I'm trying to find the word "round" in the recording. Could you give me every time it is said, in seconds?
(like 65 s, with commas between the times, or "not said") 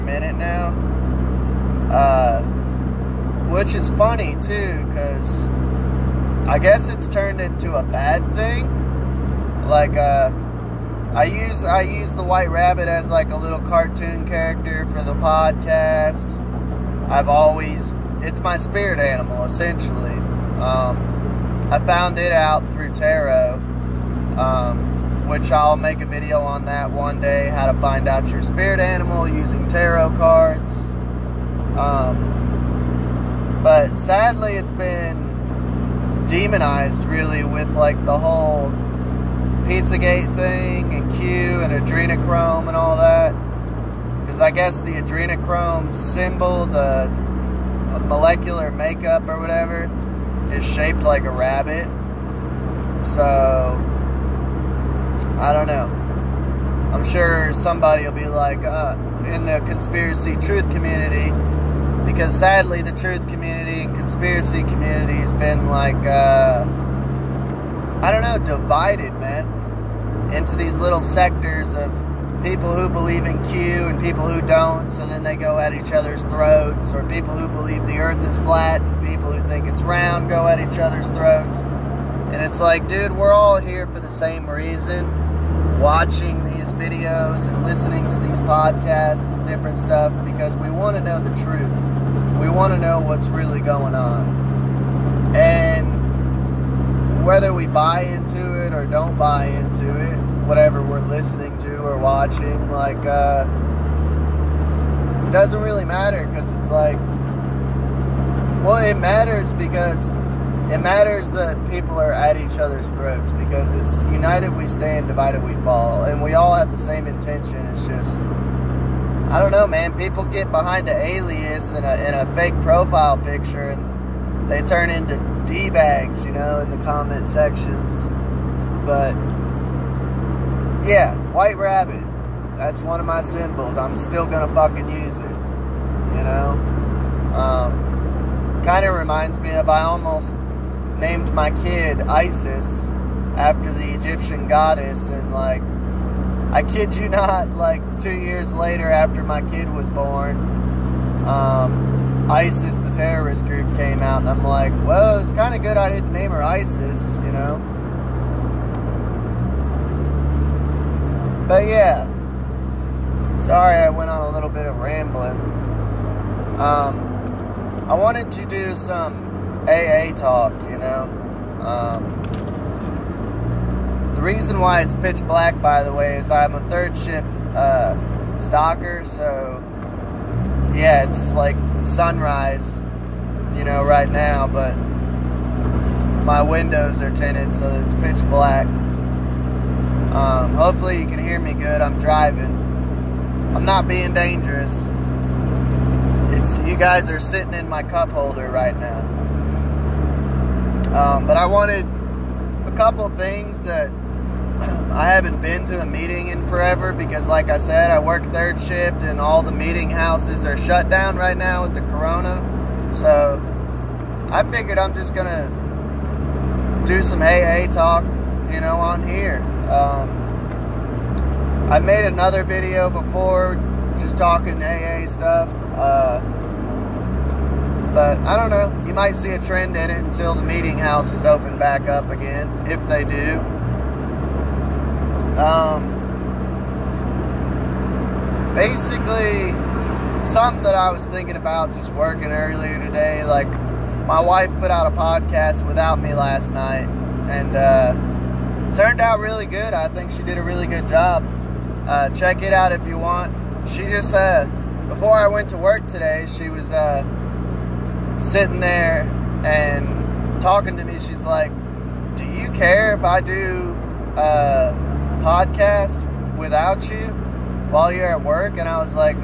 79 s.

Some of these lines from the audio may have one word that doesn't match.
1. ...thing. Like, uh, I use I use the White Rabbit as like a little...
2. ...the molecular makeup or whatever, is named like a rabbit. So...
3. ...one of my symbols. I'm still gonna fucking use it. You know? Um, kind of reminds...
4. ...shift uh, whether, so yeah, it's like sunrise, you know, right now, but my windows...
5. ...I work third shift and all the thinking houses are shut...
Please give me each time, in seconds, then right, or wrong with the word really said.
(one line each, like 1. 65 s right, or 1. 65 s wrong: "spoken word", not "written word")
1. 8 s right
2. 46 s wrong: "shaped", not "named"
3. 132 s right
4. 176 s wrong: "stalker", not "whether"
5. 207 s wrong: "meeting", not "thinking".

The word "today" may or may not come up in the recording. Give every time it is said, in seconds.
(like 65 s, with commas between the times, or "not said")
242 s, 255 s.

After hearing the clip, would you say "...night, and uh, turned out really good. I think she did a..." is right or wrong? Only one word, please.
right.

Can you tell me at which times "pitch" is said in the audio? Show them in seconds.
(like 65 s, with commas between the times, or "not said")
174 s, 187 s.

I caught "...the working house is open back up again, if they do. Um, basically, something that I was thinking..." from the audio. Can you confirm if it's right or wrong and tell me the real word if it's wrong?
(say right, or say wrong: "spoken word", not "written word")
wrong: "meeting", not "working".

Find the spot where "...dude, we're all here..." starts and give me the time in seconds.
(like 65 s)
82 s.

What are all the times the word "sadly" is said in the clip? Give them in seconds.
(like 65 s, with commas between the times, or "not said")
33 s, 62 s.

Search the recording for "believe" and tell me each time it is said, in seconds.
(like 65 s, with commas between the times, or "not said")
72 s, 77 s.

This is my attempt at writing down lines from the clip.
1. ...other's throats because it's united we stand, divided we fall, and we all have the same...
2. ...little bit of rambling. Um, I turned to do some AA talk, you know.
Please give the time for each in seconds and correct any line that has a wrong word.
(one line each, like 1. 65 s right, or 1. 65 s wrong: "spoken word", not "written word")
1. 112 s right
2. 164 s wrong: "wanted", not "turned".